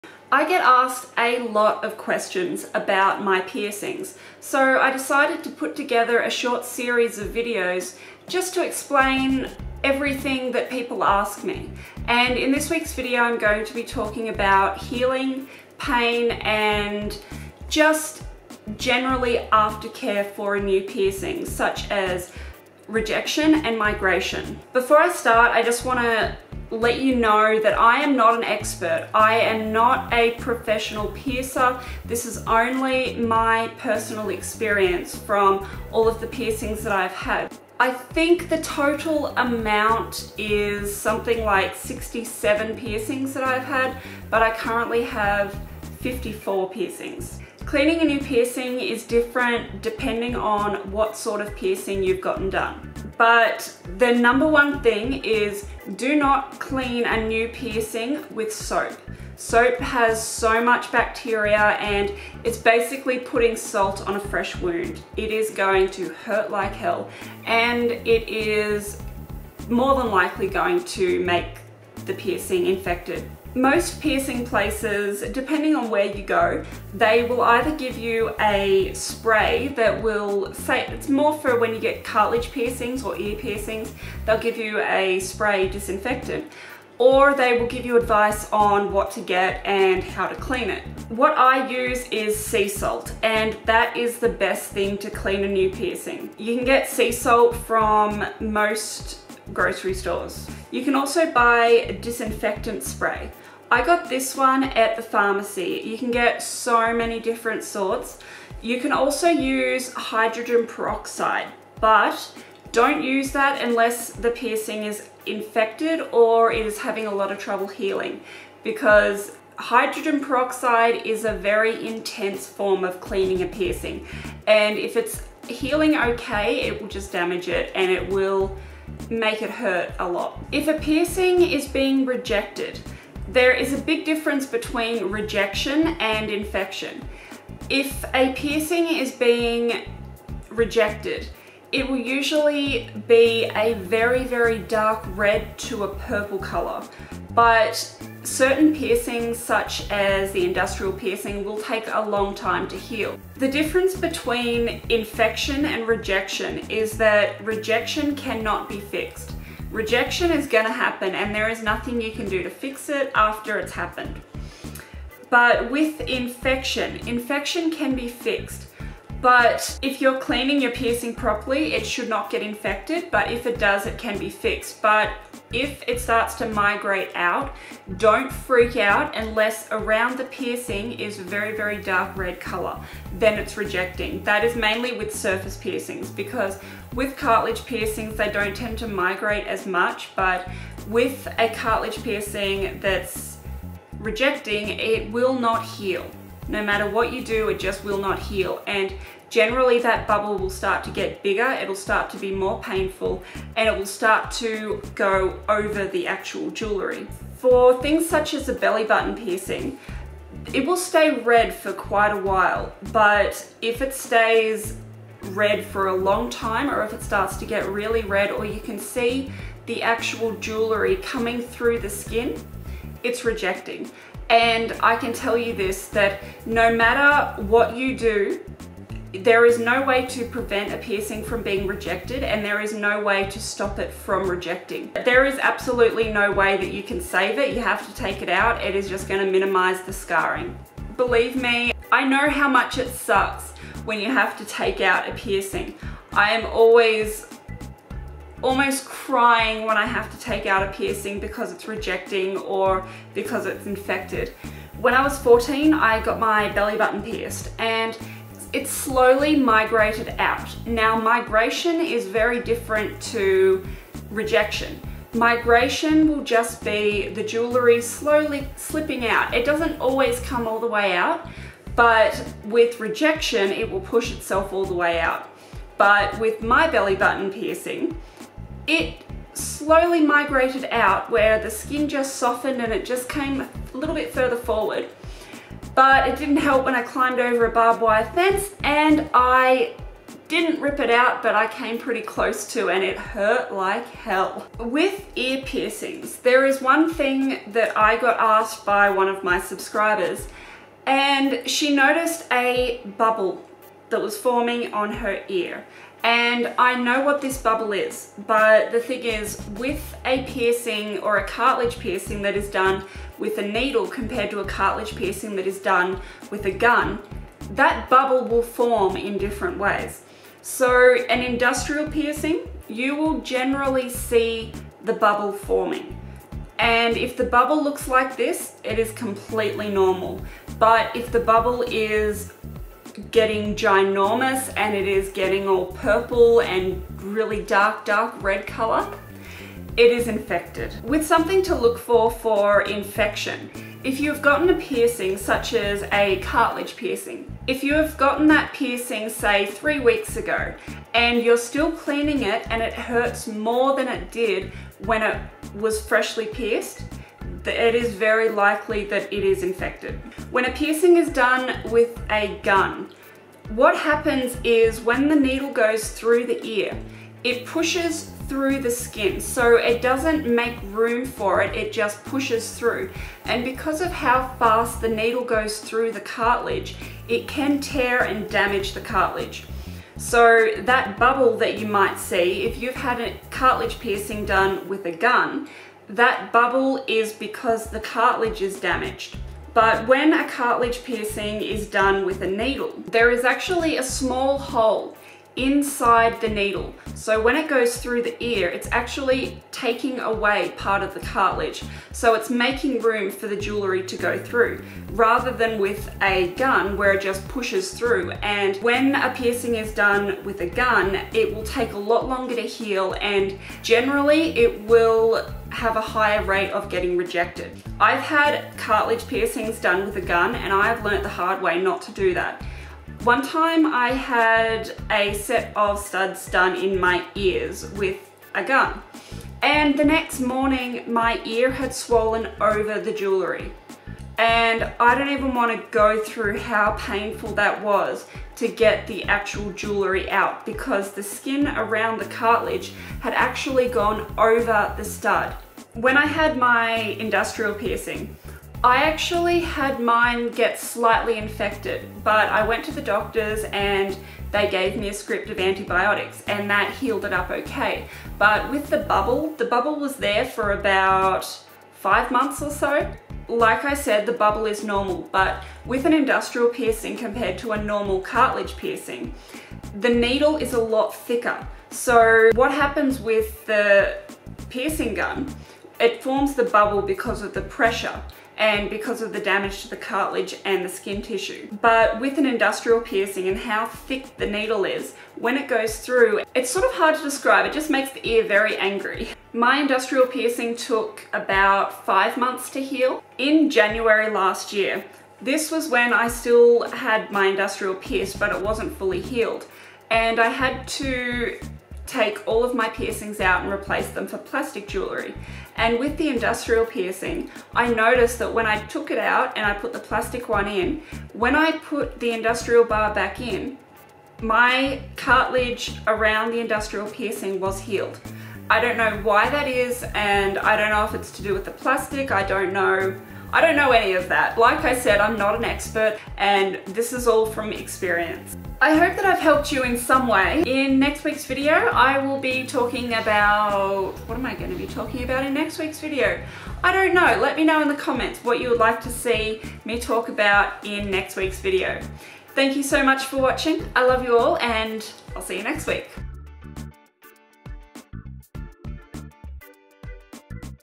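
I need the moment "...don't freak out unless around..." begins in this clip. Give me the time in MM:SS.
02:57.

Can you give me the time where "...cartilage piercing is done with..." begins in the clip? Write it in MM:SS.
06:30.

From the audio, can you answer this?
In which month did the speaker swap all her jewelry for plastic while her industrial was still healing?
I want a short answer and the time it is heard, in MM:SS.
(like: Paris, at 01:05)
January, at 08:13.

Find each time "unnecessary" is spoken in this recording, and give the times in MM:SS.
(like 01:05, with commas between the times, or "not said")
not said.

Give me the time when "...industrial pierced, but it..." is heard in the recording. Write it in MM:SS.
08:17.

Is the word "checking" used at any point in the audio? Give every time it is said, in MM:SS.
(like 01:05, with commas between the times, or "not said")
not said.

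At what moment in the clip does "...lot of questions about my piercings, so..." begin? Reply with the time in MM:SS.
00:01.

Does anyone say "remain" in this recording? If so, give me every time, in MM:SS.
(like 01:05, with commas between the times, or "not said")
not said.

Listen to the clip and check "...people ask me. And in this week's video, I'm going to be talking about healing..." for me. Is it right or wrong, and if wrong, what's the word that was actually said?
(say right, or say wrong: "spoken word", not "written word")
right.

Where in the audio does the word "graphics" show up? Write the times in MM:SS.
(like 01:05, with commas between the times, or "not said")
not said.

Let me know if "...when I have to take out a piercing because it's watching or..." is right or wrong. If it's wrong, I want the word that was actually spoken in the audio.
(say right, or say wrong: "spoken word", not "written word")
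wrong: "rejecting", not "watching".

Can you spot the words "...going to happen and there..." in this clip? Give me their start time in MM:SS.
02:40.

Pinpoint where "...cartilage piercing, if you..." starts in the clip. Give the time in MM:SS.
05:46.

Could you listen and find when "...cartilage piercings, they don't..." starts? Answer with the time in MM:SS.
03:07.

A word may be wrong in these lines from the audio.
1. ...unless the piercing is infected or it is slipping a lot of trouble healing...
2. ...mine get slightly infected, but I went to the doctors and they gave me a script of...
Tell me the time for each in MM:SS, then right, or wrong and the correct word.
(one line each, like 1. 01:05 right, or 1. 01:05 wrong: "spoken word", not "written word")
1. 01:53 wrong: "having", not "slipping"
2. 07:29 right.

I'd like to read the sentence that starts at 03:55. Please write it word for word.
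There is absolutely no way that you can save it.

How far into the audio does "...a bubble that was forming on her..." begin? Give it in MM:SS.
05:02.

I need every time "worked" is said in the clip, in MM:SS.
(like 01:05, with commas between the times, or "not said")
not said.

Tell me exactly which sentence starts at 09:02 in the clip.
Thank you so much for watching.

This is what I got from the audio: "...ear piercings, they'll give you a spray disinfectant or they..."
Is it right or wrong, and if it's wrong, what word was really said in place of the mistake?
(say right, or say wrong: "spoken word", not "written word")
right.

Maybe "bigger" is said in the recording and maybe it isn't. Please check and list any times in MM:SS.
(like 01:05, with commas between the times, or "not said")
03:21.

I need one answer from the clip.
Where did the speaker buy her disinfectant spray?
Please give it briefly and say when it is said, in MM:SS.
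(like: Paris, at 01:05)
The pharmacy, at 01:44.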